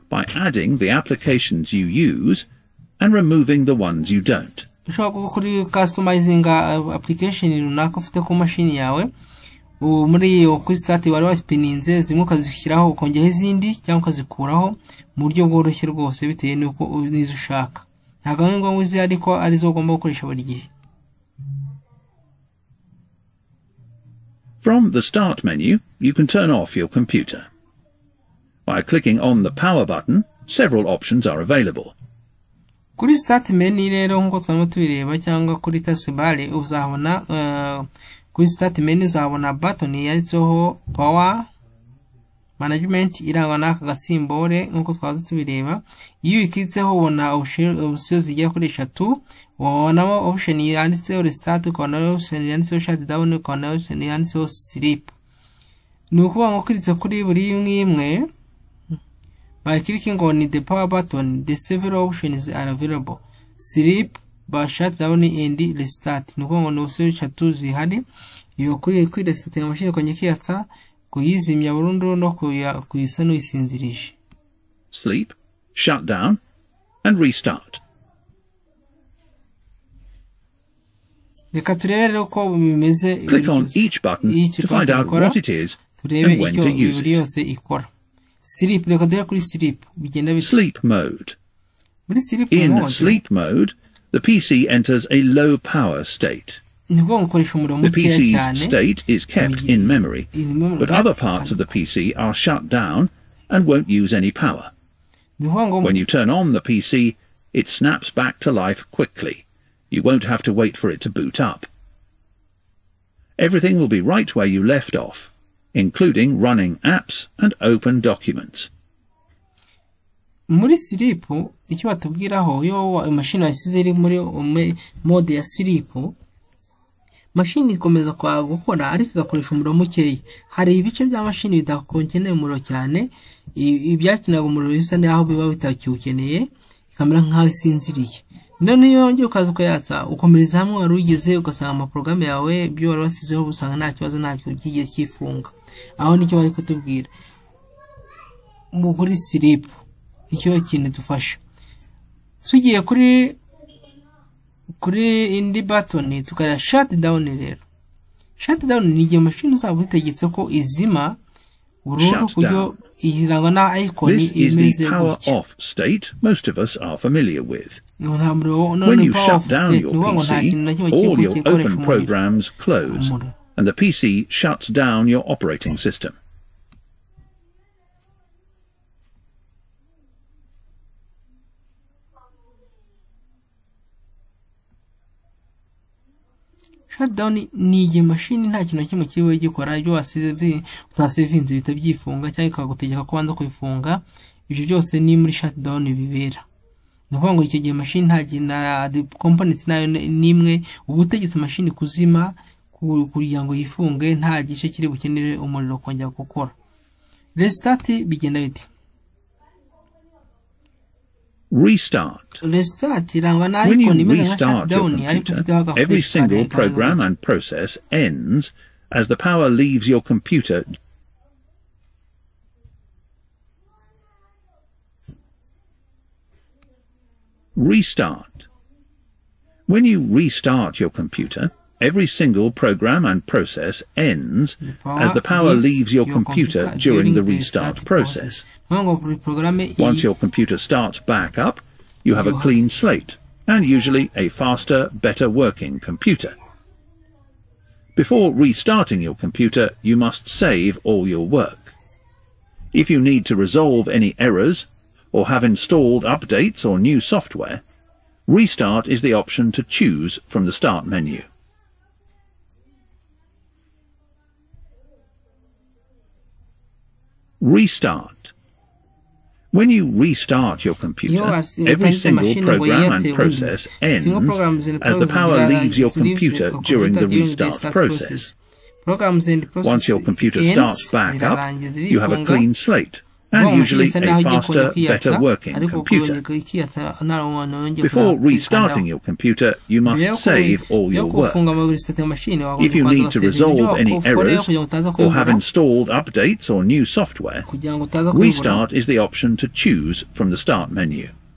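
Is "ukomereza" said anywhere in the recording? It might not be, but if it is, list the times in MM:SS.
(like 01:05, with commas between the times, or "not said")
02:20.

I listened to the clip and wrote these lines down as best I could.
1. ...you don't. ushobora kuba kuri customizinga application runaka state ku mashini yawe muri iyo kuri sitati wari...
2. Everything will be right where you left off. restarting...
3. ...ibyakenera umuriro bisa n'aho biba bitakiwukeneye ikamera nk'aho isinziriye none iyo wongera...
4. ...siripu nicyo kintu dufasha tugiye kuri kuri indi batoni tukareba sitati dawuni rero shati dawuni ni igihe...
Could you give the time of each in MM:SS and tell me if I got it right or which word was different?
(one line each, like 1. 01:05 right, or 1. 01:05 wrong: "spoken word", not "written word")
1. 00:04 wrong: "ufite", not "state"
2. 01:53 wrong: "including", not "restarting"
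3. 02:13 right
4. 02:29 wrong: "shati", not "sitati".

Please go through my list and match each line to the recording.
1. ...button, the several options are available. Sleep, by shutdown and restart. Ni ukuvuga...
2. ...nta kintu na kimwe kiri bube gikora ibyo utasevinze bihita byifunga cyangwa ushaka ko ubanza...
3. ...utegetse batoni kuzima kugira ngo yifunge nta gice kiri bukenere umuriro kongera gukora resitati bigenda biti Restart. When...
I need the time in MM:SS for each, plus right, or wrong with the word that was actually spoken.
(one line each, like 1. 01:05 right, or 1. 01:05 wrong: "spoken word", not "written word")
1. 01:00 right
2. 03:08 wrong: "ikagutegeka", not "ushaka"
3. 03:21 wrong: "mashini", not "batoni".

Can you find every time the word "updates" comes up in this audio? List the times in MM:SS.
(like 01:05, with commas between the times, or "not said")
04:16, 04:55.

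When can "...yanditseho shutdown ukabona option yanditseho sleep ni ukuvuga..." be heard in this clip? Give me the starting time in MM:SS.
00:52.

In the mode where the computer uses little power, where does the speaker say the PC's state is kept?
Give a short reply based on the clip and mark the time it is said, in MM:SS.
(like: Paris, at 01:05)
In memory, at 01:39.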